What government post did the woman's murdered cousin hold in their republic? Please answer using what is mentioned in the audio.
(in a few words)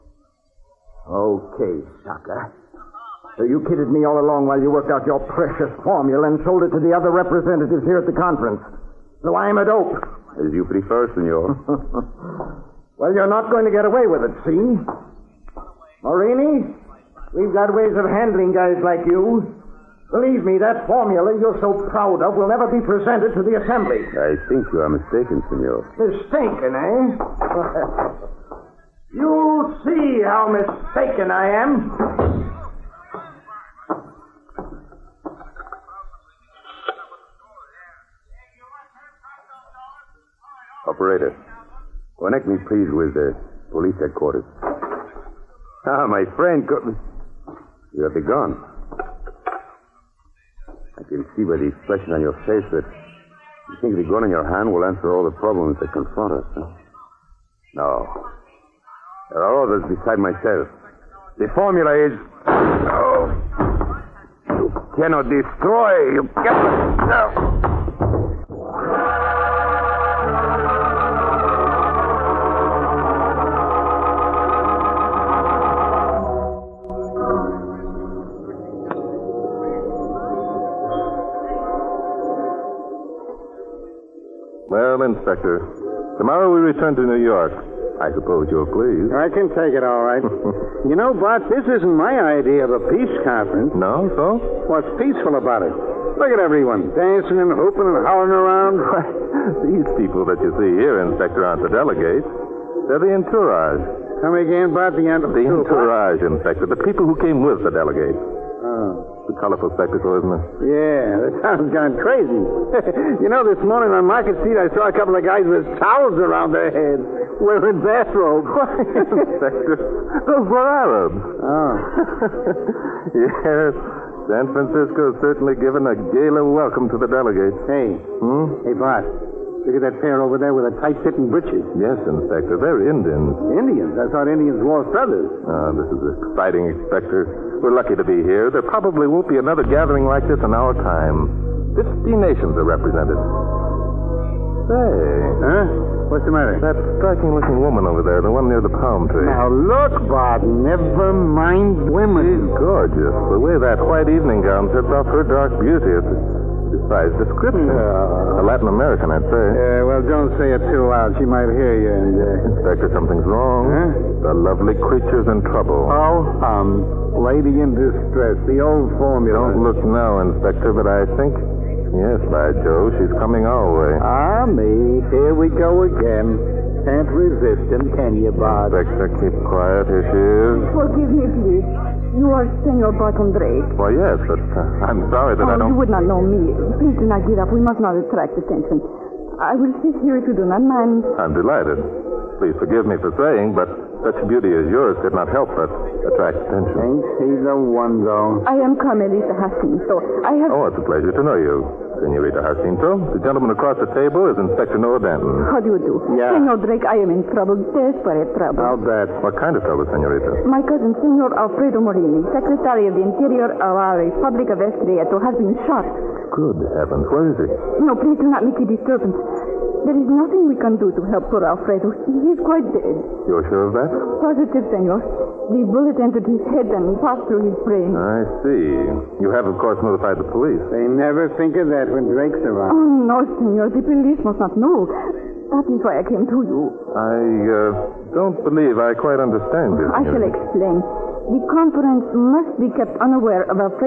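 Secretary of the Interior.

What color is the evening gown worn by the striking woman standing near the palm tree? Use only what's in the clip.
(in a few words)
White.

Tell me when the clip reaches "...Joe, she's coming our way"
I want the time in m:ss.
2:52.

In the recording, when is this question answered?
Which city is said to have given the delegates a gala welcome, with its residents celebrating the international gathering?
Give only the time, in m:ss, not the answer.
2:04.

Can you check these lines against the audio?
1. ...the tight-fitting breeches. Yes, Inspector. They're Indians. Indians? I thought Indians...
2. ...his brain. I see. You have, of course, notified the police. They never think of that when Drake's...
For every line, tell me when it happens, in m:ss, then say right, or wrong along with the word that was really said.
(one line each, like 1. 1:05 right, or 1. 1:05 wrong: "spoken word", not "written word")
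1. 2:10 right
2. 3:47 right.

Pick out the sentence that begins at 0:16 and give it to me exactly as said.
Morini, we've got ways of handling guys like you.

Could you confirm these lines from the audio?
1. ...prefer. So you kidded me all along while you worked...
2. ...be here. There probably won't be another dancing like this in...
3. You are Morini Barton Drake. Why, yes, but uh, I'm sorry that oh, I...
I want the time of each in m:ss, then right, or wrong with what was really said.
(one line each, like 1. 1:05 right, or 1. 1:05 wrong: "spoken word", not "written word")
1. 0:02 wrong: "sucker", not "prefer"
2. 2:18 wrong: "gathering", not "dancing"
3. 3:02 wrong: "Senor", not "Morini".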